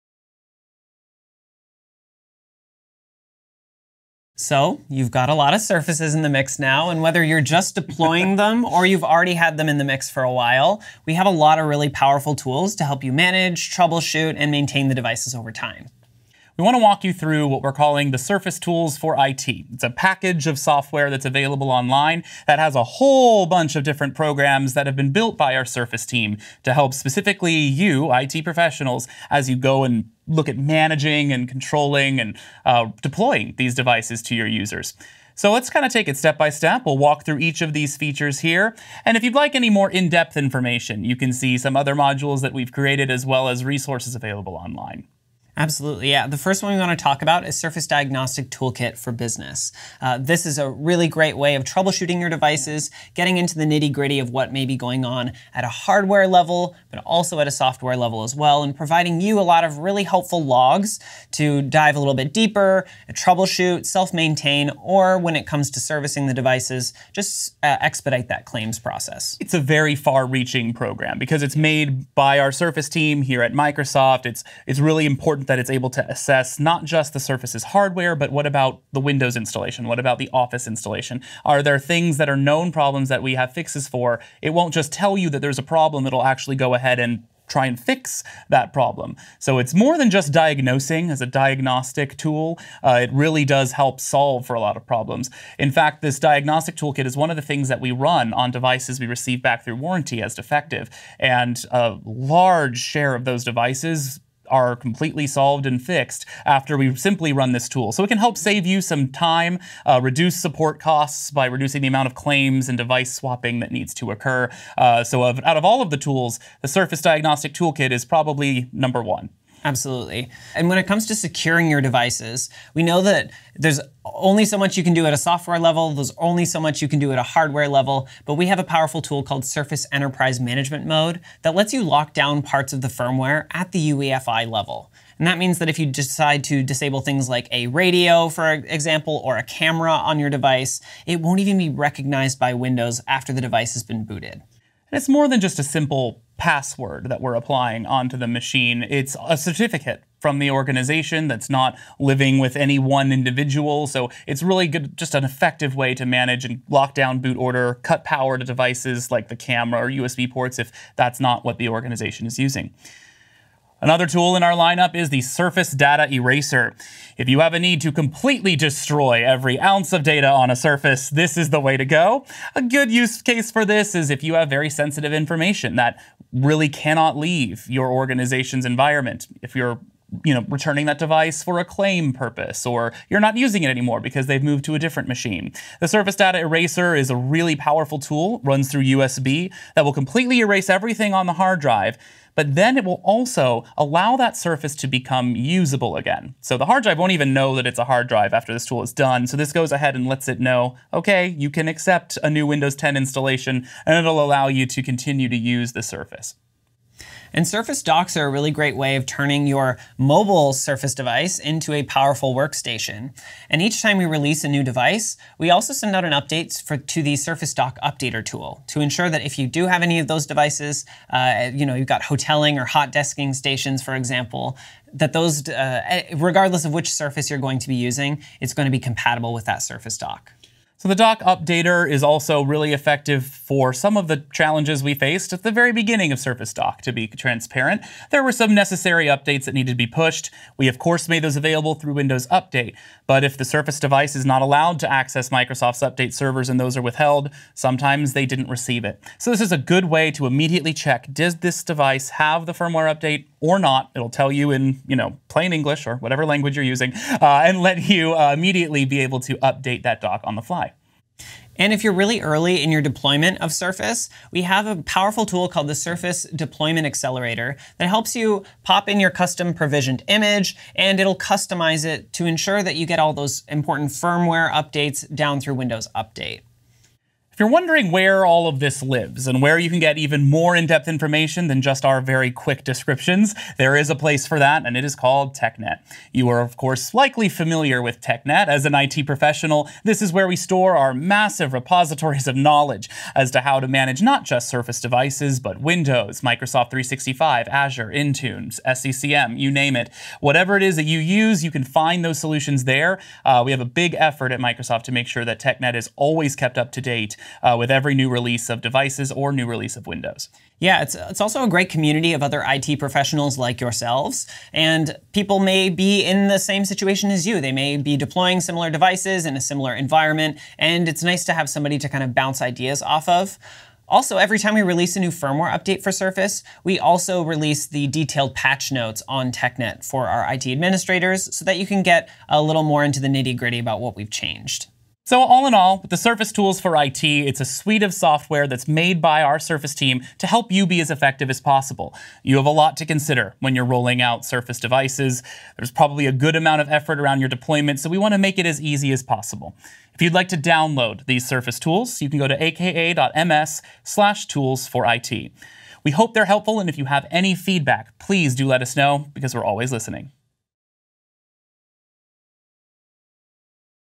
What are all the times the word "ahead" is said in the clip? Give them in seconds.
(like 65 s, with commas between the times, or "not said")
86 s, 199 s.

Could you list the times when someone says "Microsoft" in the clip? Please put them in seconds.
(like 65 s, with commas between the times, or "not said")
73 s, 245 s, 296 s, 304 s.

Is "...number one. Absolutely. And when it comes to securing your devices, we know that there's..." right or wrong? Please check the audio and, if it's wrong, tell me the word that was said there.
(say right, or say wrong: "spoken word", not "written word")
right.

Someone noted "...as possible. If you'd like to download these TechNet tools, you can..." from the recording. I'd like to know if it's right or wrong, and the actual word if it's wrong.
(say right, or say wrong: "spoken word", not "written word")
wrong: "Surface", not "TechNet".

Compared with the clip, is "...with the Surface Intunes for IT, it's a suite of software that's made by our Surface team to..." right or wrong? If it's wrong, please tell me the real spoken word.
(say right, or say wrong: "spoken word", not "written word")
wrong: "Tools", not "Intunes".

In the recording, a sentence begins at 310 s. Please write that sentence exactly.
Yeah, it's, it's also a great community of other IT professionals like yourselves.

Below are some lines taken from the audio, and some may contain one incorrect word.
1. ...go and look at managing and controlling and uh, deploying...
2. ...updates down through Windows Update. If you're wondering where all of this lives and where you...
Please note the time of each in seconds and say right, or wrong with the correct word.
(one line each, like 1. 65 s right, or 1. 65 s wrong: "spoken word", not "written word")
1. 29 s right
2. 274 s right.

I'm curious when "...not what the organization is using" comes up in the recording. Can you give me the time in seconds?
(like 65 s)
161 s.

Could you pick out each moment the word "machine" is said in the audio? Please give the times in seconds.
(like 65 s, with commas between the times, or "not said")
148 s, 185 s.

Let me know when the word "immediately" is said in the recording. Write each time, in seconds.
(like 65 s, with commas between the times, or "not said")
250 s, 258 s.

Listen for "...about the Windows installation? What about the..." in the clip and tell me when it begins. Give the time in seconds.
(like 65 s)
78 s.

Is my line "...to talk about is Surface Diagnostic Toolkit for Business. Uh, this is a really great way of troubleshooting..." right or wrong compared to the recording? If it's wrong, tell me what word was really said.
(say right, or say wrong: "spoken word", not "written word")
right.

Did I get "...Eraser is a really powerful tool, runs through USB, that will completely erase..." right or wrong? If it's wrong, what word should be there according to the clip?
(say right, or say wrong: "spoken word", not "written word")
right.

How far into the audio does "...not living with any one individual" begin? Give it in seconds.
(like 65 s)
151 s.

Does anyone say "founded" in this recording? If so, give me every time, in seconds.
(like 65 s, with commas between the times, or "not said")
not said.